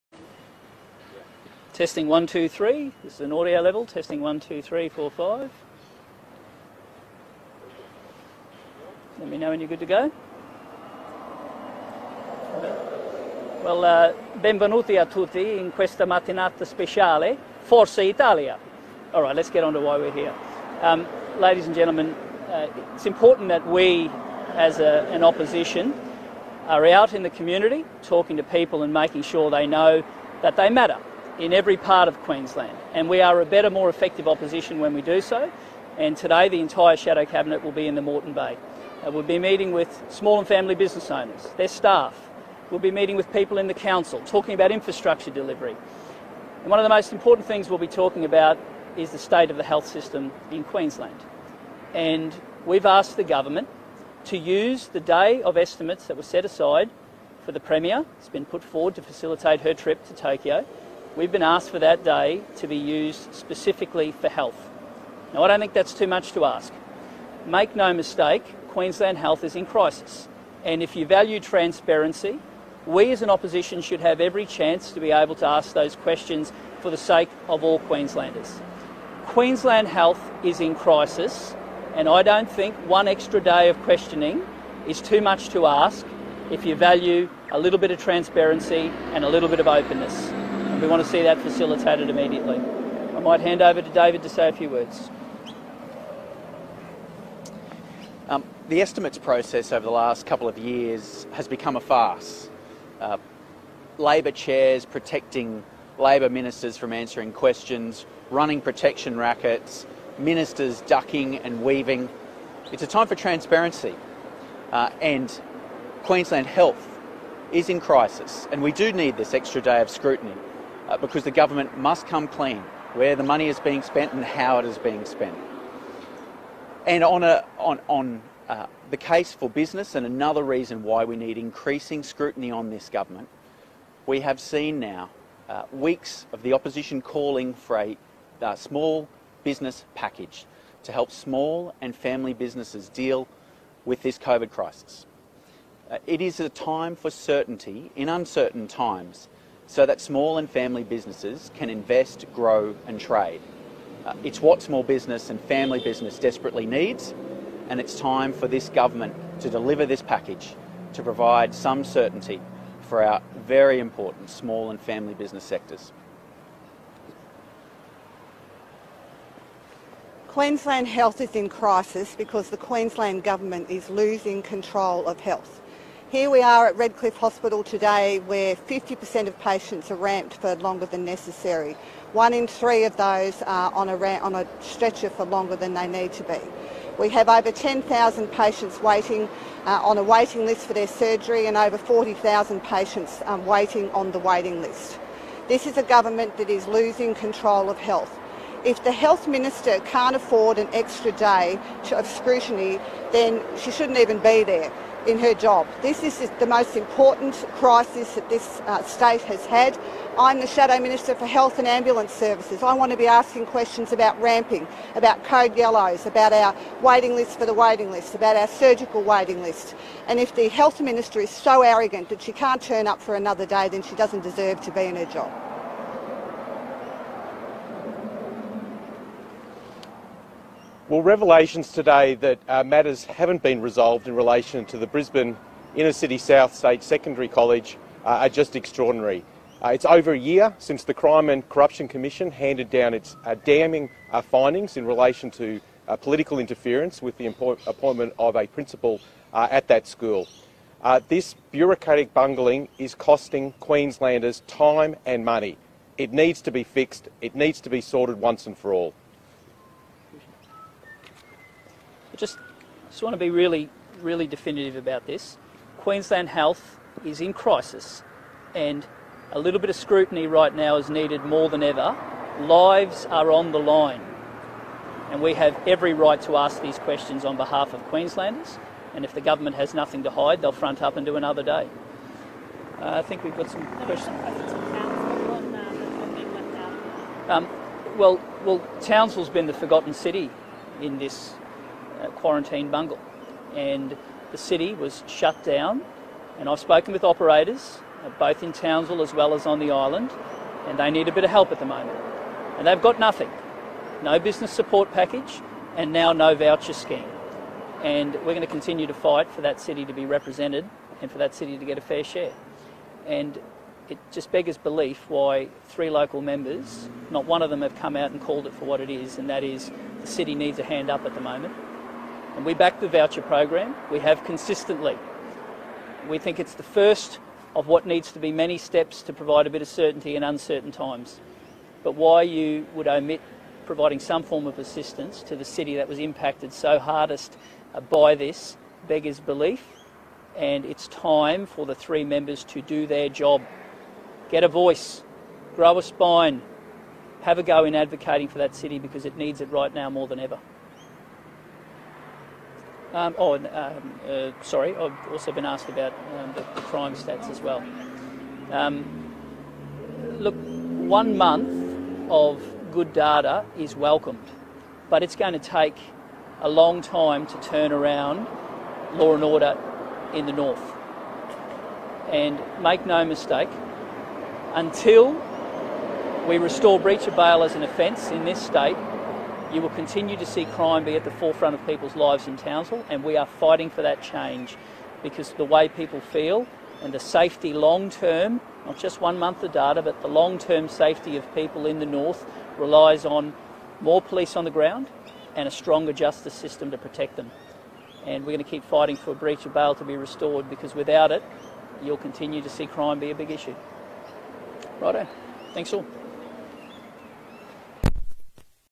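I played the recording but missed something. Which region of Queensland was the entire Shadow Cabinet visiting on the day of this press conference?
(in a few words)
Moreton Bay.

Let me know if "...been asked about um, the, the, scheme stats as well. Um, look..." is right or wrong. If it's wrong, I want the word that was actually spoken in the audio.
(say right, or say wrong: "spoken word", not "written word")
wrong: "crime", not "scheme".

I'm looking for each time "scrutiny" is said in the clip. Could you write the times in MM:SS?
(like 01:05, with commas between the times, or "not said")
01:59, 02:12, 03:22, 04:29.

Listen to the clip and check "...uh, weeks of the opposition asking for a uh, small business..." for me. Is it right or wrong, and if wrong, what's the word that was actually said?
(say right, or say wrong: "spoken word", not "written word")
wrong: "calling", not "asking".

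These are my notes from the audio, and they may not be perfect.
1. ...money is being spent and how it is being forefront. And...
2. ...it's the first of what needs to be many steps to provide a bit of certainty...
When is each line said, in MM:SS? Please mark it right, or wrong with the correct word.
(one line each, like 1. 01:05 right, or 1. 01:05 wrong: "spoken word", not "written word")
1. 02:03 wrong: "spent", not "forefront"
2. 05:26 right.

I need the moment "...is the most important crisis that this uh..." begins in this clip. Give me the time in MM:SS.
03:26.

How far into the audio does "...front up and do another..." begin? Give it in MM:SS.
04:40.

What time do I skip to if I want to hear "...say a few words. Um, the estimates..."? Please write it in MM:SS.
01:34.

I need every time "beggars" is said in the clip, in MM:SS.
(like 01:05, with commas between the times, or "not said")
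05:14, 05:38.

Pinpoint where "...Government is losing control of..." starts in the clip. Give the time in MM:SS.
02:53.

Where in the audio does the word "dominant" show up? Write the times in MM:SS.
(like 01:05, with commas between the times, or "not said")
not said.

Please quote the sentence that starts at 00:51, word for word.
And we've asked the government to use the day of estimates that were set aside for the Premier.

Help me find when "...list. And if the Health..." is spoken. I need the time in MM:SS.
03:39.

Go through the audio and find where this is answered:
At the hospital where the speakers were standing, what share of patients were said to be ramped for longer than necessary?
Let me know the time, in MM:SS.
02:58.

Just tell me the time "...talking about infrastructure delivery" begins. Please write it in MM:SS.
00:44.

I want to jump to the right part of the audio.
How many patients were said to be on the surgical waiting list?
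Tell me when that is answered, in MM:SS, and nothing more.
03:11.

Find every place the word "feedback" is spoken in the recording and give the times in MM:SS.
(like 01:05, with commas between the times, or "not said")
not said.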